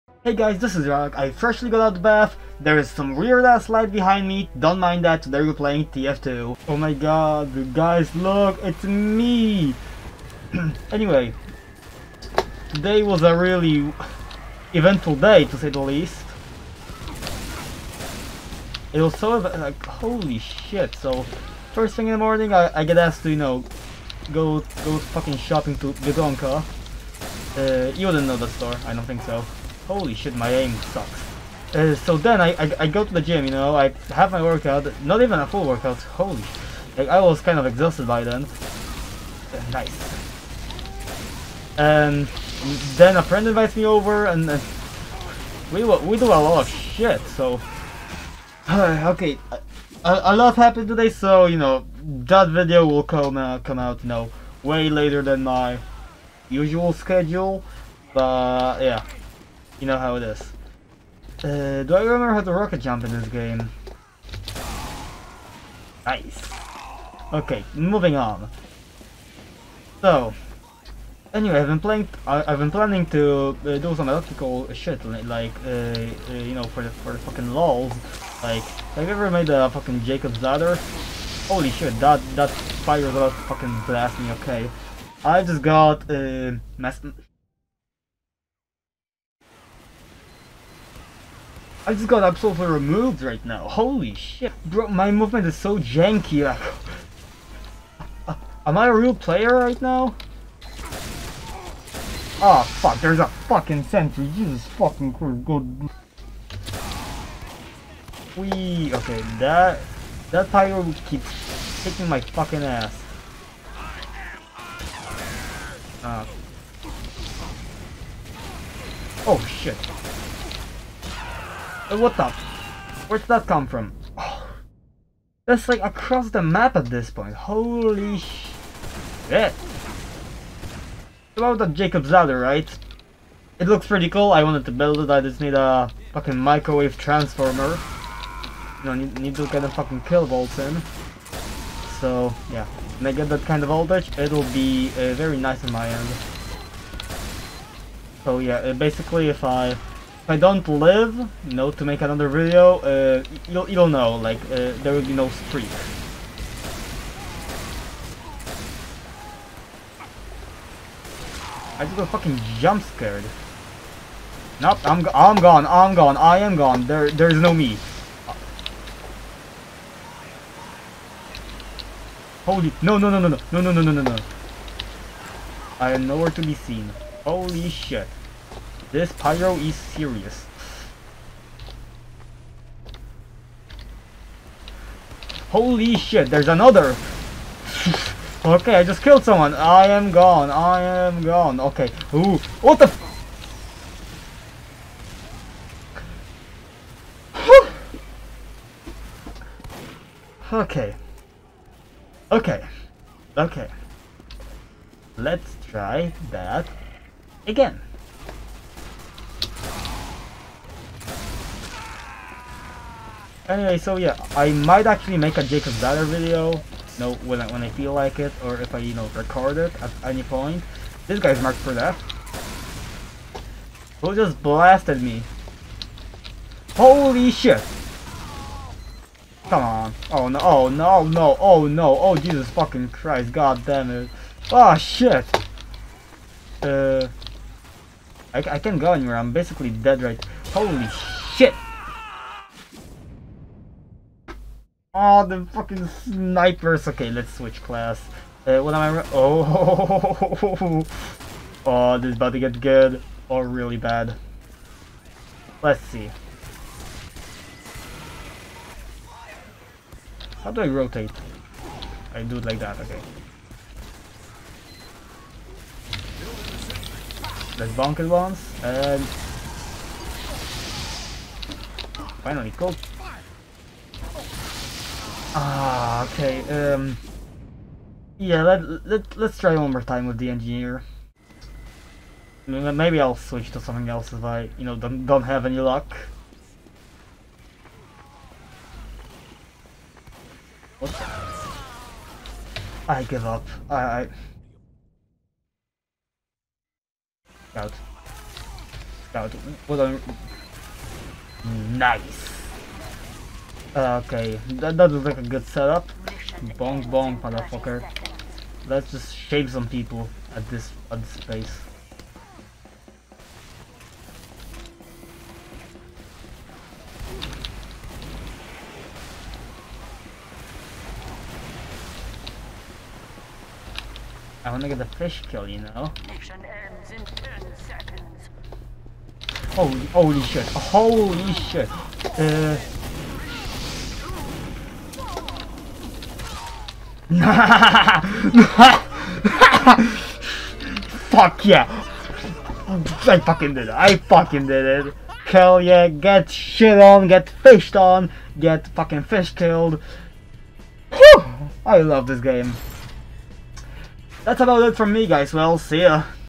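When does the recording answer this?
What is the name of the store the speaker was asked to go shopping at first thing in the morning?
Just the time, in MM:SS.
00:25.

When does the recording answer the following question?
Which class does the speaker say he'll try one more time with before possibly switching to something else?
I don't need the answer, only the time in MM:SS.
04:40.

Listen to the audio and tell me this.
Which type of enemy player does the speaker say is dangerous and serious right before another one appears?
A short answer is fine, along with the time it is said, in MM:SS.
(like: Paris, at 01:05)
Pyro, at 02:59.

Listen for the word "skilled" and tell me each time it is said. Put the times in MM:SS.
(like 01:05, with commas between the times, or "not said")
not said.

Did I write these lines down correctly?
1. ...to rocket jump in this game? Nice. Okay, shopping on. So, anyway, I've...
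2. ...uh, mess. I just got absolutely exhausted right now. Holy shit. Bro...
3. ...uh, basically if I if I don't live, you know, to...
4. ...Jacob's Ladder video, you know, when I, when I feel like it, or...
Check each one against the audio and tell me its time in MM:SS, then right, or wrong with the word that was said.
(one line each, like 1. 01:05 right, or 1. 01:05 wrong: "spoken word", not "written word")
1. 01:02 wrong: "moving", not "shopping"
2. 01:26 wrong: "removed", not "exhausted"
3. 02:28 right
4. 03:35 right.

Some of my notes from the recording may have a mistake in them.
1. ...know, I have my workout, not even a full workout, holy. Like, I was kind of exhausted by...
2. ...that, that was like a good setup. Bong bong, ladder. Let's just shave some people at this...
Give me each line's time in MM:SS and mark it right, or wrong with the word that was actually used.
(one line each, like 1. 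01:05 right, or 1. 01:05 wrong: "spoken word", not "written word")
1. 00:33 right
2. 05:04 wrong: "motherfucker", not "ladder".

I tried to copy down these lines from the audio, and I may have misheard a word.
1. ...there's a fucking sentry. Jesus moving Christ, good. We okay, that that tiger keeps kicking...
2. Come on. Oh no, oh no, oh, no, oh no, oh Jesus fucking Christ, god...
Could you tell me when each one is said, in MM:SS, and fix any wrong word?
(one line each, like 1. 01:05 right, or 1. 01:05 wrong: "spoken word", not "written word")
1. 01:43 wrong: "fucking", not "moving"
2. 03:49 right.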